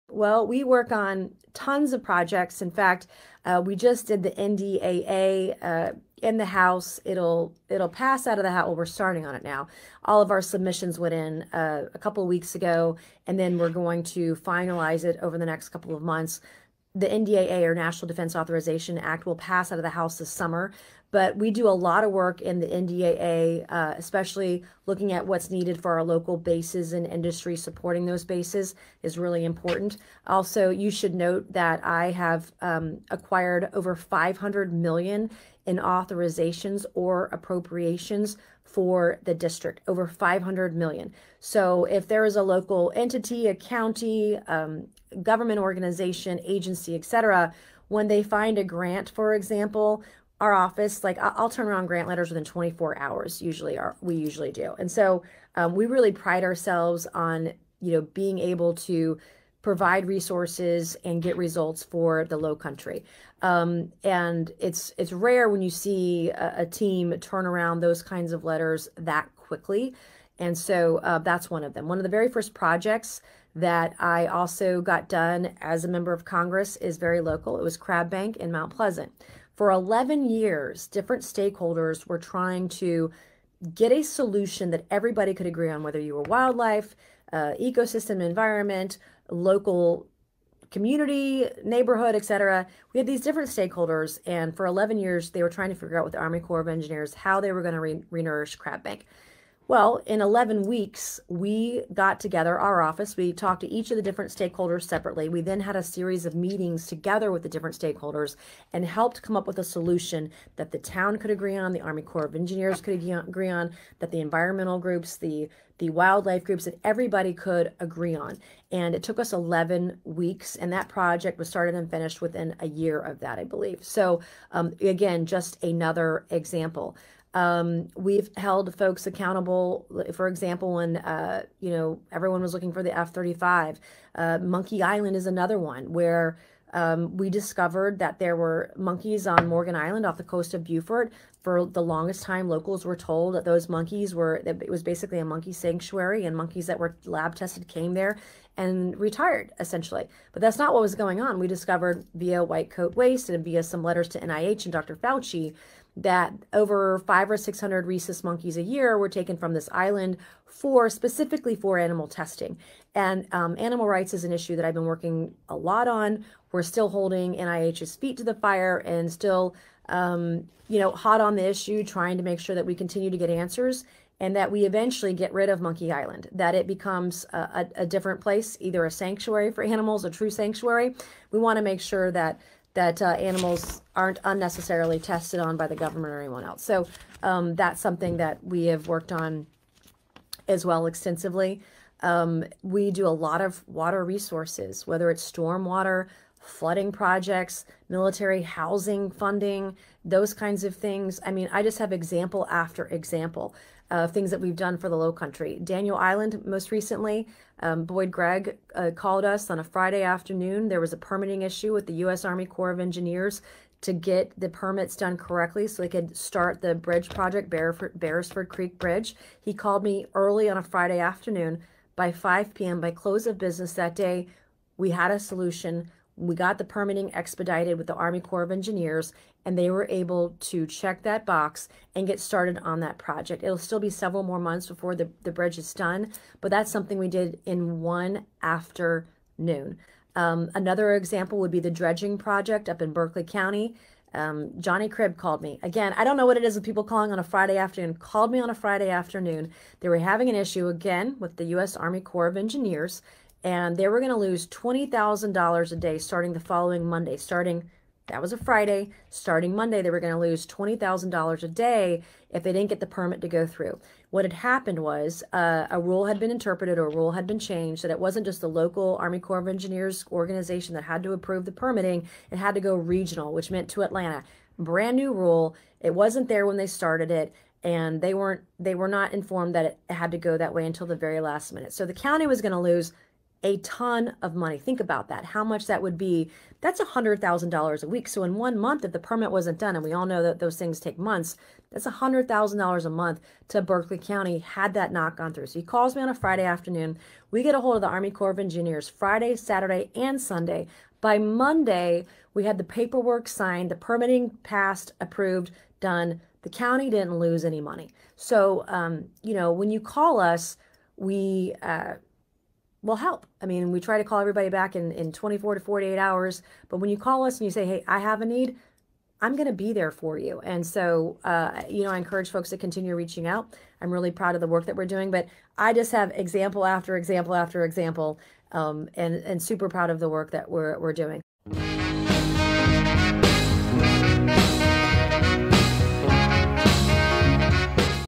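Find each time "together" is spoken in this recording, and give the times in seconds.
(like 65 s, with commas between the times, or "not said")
102 s, 106 s.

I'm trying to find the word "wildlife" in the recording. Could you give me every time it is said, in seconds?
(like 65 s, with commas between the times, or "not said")
86 s, 115 s.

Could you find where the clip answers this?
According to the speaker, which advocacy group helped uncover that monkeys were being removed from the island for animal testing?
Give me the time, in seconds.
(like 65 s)
152 s.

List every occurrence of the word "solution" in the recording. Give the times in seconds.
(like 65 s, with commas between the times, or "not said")
84 s, 109 s, 225 s.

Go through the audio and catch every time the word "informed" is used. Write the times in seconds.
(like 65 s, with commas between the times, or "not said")
279 s.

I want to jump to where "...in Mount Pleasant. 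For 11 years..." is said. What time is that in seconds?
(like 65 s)
78 s.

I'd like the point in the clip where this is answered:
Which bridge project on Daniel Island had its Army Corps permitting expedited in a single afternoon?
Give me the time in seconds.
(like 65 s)
217 s.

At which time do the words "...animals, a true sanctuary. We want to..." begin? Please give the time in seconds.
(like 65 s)
179 s.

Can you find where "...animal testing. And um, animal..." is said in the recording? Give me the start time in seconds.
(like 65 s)
161 s.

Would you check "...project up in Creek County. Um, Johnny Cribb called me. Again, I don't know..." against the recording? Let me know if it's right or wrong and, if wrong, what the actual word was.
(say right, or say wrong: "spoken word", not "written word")
wrong: "Berkeley", not "Creek".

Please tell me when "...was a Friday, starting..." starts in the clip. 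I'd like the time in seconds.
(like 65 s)
258 s.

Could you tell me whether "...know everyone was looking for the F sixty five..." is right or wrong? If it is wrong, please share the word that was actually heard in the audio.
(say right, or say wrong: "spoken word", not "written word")
wrong: "thirty", not "sixty".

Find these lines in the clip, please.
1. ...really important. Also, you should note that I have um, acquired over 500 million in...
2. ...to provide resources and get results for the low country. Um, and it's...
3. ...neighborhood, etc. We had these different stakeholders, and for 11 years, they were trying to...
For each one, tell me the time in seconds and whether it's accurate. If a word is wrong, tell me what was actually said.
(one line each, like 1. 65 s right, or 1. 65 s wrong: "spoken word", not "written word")
1. 29 s right
2. 58 s right
3. 91 s right.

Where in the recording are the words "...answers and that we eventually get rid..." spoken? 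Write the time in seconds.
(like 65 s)
173 s.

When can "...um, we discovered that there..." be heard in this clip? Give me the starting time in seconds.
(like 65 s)
136 s.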